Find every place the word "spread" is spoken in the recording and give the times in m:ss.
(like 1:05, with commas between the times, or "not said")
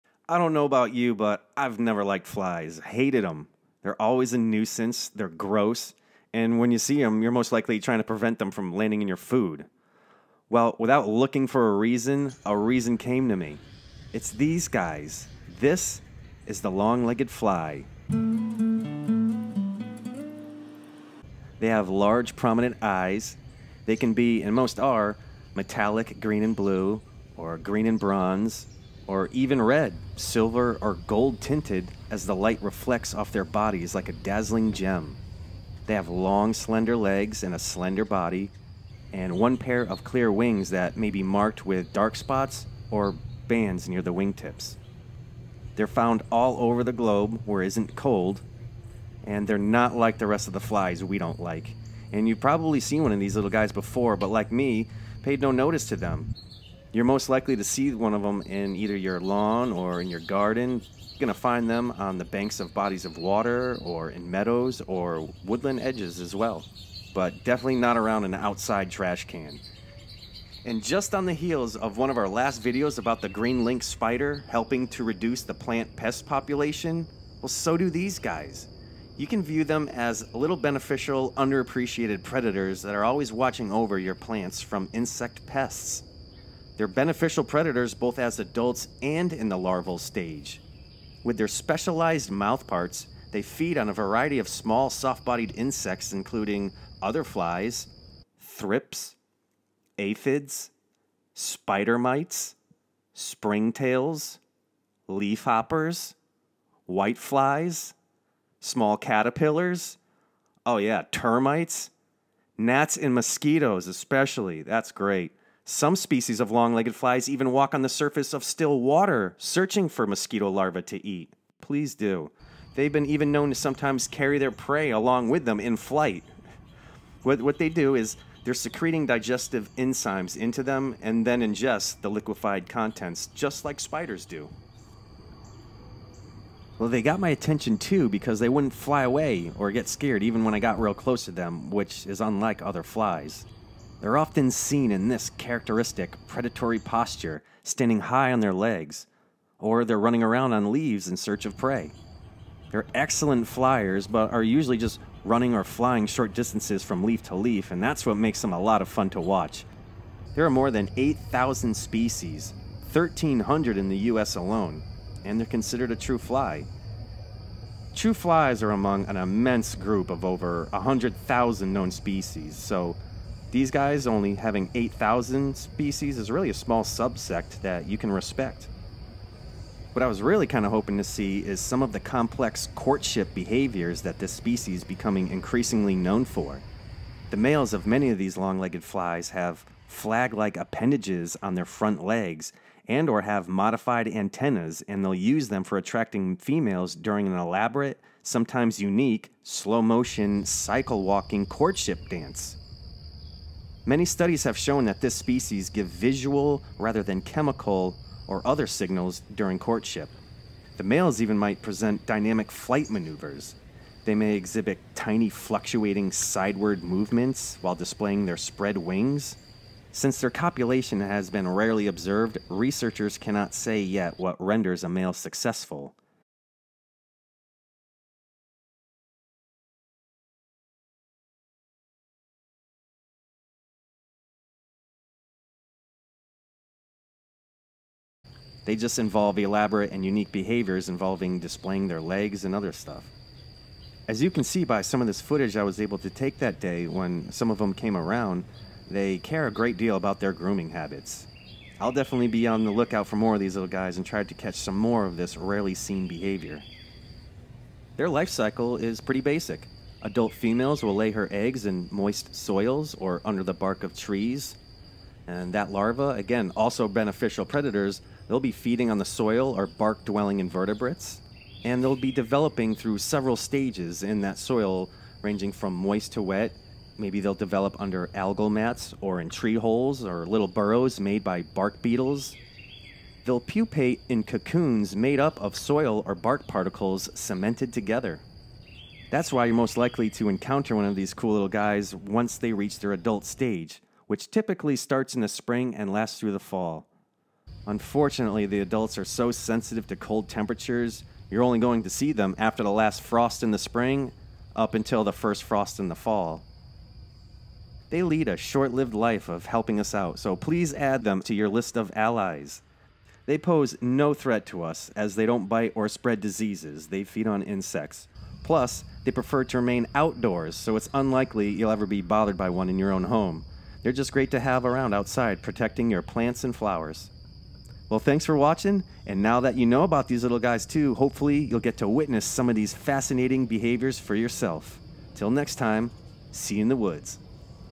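3:38, 5:15.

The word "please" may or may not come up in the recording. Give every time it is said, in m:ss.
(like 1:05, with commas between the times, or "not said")
2:01, 5:10.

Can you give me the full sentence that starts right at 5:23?
They're just great to have around outside, protecting your plants and flowers.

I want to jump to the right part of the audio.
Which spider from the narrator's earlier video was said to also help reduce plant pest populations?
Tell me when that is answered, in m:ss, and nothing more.
1:13.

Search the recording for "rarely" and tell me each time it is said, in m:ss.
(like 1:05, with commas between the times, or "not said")
3:41, 4:15.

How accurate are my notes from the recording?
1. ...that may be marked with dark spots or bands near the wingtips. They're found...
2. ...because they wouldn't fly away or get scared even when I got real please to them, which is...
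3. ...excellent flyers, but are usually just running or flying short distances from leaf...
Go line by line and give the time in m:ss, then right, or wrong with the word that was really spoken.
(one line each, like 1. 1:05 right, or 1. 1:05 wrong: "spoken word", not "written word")
1. 0:40 right
2. 2:18 wrong: "close", not "please"
3. 2:32 right.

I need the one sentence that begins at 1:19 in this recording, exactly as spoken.
You can view them as little beneficial, underappreciated predators that are always watching over your plants from insect pests.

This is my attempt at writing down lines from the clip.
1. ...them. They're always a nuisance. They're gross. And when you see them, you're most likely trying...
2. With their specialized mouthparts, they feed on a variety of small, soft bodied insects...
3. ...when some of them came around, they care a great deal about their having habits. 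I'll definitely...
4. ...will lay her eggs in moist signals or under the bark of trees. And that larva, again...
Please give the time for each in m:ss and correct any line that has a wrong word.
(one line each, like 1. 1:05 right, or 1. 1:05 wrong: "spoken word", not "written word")
1. 0:03 right
2. 1:31 right
3. 4:06 wrong: "grooming", not "having"
4. 4:20 wrong: "soils", not "signals".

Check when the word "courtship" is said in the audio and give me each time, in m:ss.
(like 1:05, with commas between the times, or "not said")
3:02, 3:21, 3:29.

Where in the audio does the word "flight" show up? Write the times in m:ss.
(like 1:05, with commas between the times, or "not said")
2:05, 3:32.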